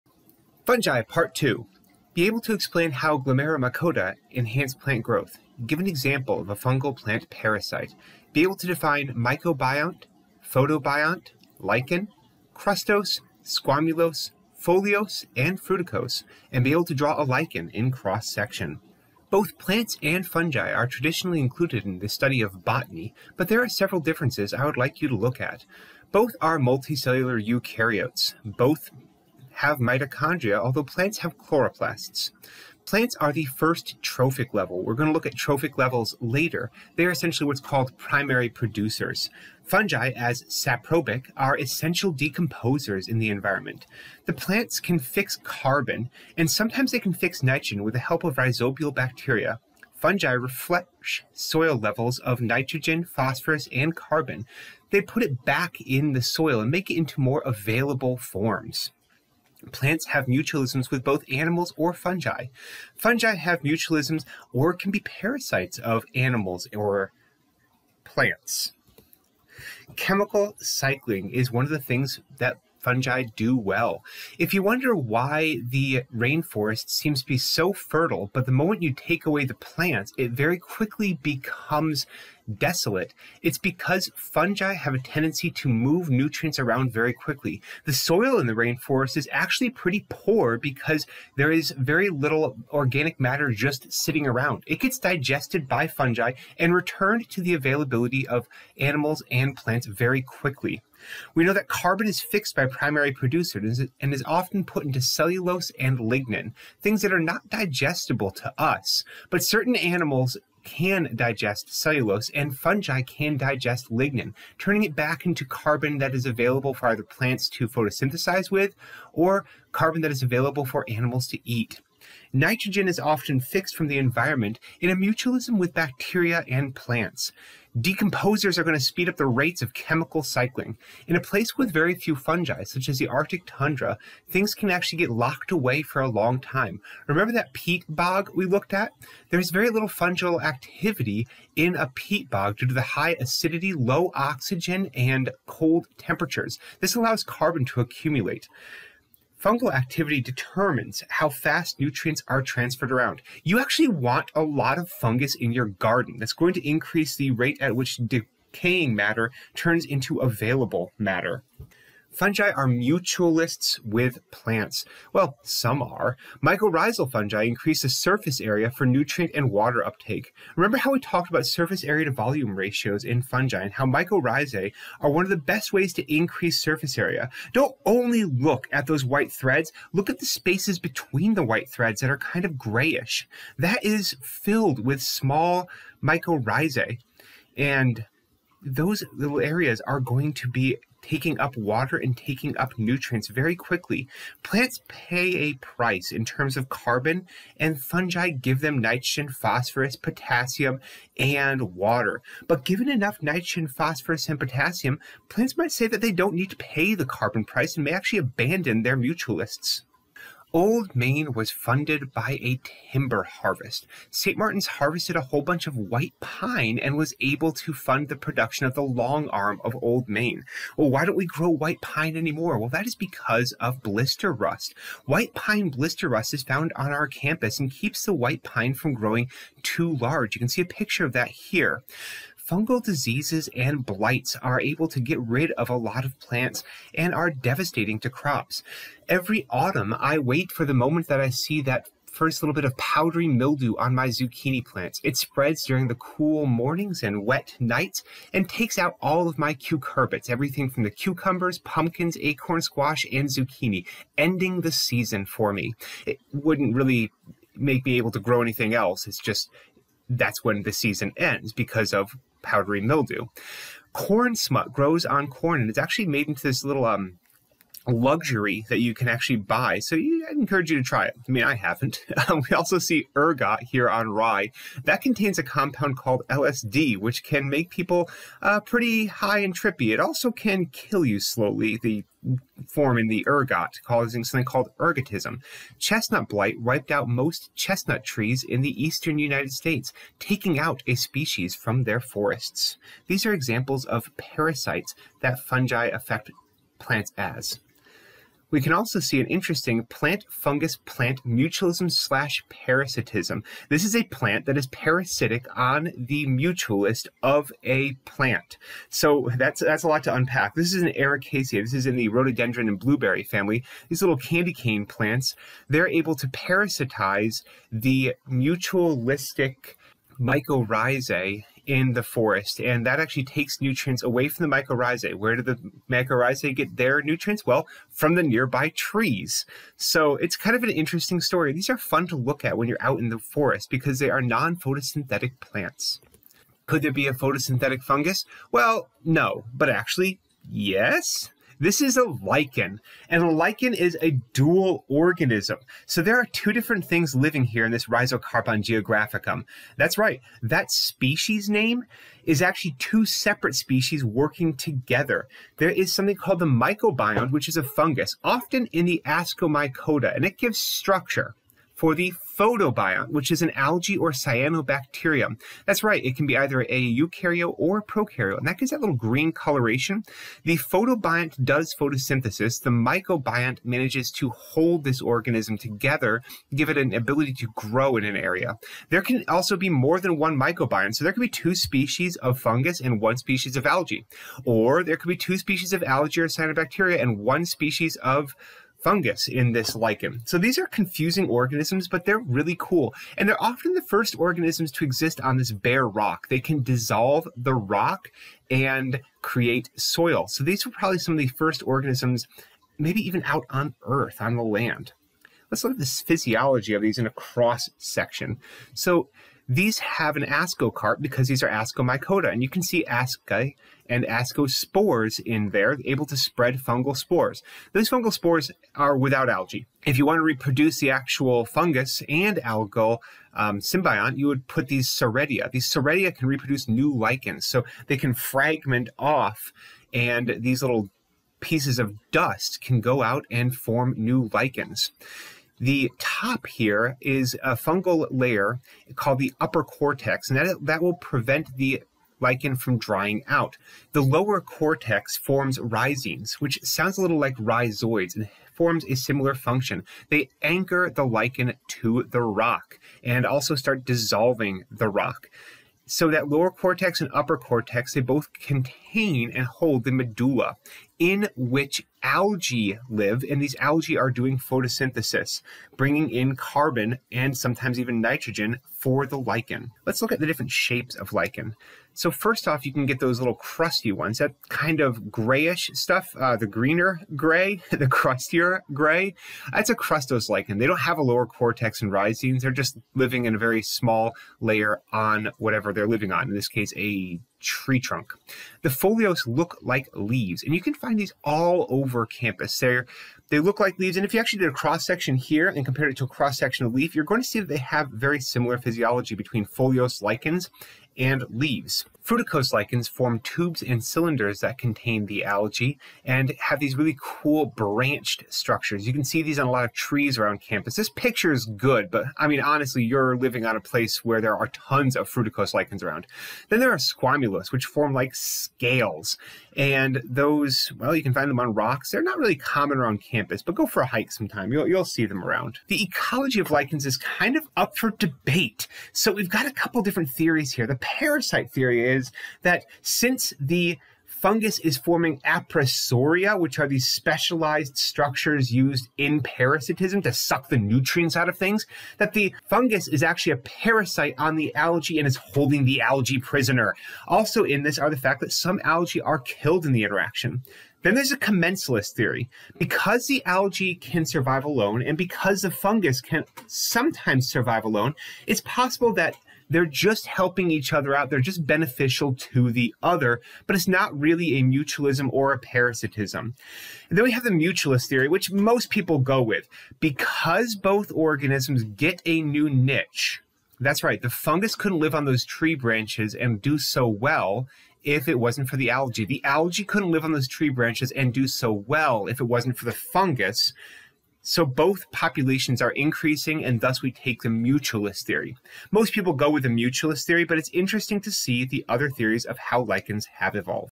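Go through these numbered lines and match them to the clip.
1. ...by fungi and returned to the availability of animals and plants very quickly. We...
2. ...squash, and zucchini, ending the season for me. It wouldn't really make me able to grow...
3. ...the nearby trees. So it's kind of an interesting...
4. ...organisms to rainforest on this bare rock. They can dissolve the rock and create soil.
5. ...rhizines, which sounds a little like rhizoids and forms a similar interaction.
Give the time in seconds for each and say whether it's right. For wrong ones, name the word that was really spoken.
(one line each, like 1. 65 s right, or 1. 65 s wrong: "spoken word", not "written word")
1. 95 s right
2. 252 s right
3. 328 s right
4. 394 s wrong: "exist", not "rainforest"
5. 445 s wrong: "function", not "interaction".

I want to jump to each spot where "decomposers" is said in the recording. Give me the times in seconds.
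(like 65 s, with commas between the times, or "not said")
42 s, 127 s.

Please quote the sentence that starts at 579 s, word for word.
The algae couldn't live on those tree branches and do so well if it wasn't for the fungus.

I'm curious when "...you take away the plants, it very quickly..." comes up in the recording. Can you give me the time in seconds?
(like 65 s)
78 s.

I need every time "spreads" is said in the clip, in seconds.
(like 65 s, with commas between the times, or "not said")
245 s, 416 s.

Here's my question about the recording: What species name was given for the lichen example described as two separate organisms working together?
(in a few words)
Rhizocarpon geographicum.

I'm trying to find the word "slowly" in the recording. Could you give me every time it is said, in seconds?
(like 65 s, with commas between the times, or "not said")
281 s.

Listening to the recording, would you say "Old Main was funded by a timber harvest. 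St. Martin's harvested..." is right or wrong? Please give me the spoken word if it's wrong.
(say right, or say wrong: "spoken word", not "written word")
right.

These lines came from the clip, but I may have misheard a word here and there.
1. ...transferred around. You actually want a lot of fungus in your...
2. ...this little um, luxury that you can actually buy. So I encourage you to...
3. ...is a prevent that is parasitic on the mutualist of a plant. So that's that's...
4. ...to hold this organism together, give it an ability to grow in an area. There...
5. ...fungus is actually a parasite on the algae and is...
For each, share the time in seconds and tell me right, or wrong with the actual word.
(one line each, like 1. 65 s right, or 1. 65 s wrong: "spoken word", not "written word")
1. 152 s right
2. 266 s right
3. 303 s wrong: "plant", not "prevent"
4. 374 s right
5. 542 s right.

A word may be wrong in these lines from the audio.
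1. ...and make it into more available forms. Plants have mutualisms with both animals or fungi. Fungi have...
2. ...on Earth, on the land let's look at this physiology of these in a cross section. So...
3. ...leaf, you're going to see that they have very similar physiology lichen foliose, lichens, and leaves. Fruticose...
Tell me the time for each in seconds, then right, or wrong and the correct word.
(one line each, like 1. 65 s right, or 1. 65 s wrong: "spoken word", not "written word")
1. 56 s right
2. 403 s right
3. 496 s wrong: "between", not "lichen".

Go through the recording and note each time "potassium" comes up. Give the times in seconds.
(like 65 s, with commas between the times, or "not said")
199 s, 204 s.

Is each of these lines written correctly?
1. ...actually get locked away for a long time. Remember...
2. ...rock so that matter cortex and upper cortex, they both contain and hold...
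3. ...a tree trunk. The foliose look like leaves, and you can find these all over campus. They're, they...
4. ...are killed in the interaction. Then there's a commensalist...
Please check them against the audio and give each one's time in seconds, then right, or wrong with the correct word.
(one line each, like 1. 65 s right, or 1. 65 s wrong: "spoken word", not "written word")
1. 134 s right
2. 454 s wrong: "lower", not "matter"
3. 486 s right
4. 549 s right.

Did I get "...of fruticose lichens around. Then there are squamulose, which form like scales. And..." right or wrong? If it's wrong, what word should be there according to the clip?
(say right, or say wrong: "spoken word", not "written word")
right.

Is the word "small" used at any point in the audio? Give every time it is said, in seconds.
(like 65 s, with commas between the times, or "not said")
185 s, 483 s.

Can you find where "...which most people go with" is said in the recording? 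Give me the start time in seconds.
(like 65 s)
568 s.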